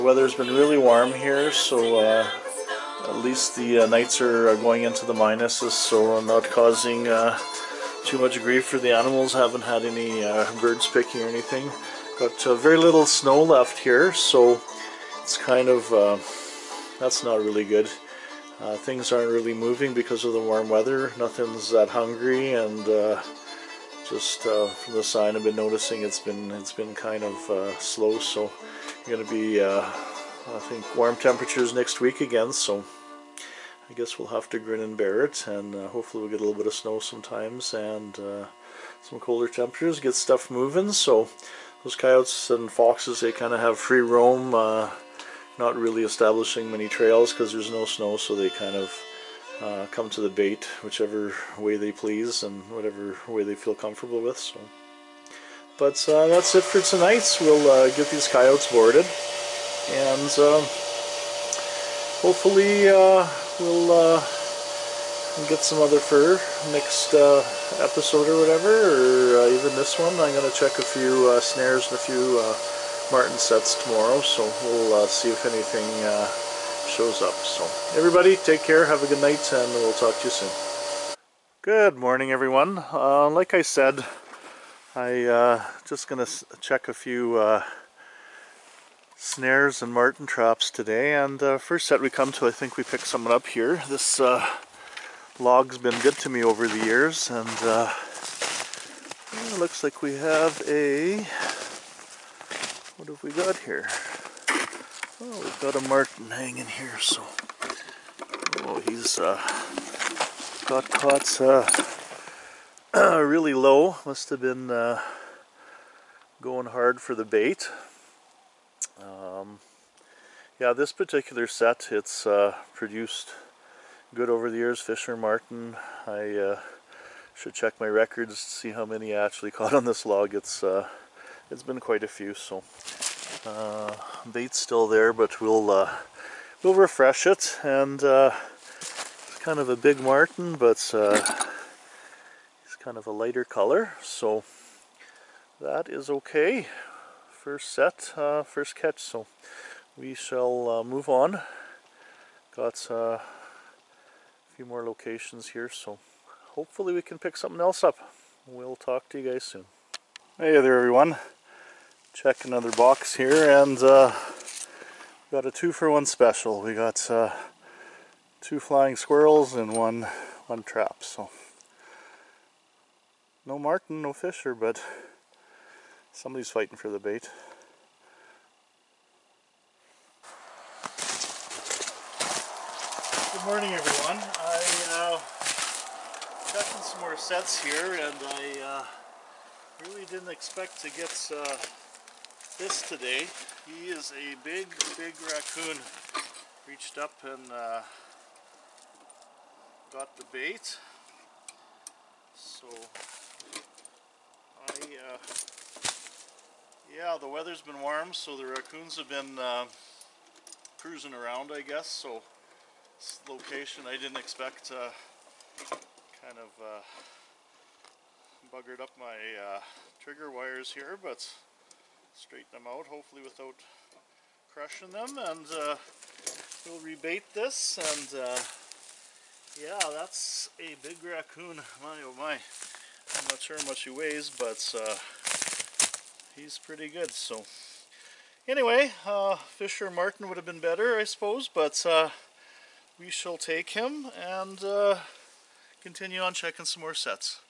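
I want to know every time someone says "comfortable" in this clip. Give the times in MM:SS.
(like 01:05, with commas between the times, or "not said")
00:53.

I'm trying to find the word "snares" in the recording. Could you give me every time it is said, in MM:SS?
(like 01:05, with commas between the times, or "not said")
01:11, 01:29.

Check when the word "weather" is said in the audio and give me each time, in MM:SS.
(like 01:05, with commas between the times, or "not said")
00:00, 00:20, 03:27.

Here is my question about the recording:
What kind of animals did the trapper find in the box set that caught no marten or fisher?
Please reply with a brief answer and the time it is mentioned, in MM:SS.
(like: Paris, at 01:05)
flying squirrels, at 02:48.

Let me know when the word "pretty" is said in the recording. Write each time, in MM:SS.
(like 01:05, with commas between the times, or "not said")
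03:56.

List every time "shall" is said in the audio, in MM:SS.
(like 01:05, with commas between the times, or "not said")
02:30, 04:03.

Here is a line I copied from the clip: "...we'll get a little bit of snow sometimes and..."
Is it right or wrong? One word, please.
right.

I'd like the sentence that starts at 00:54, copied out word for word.
So, But uh, that's it for tonight.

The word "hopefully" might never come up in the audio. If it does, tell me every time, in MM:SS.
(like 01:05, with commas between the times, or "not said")
00:35, 01:02, 02:36, 03:42.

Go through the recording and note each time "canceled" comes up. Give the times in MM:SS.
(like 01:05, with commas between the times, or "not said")
not said.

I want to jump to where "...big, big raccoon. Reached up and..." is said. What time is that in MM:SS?
03:14.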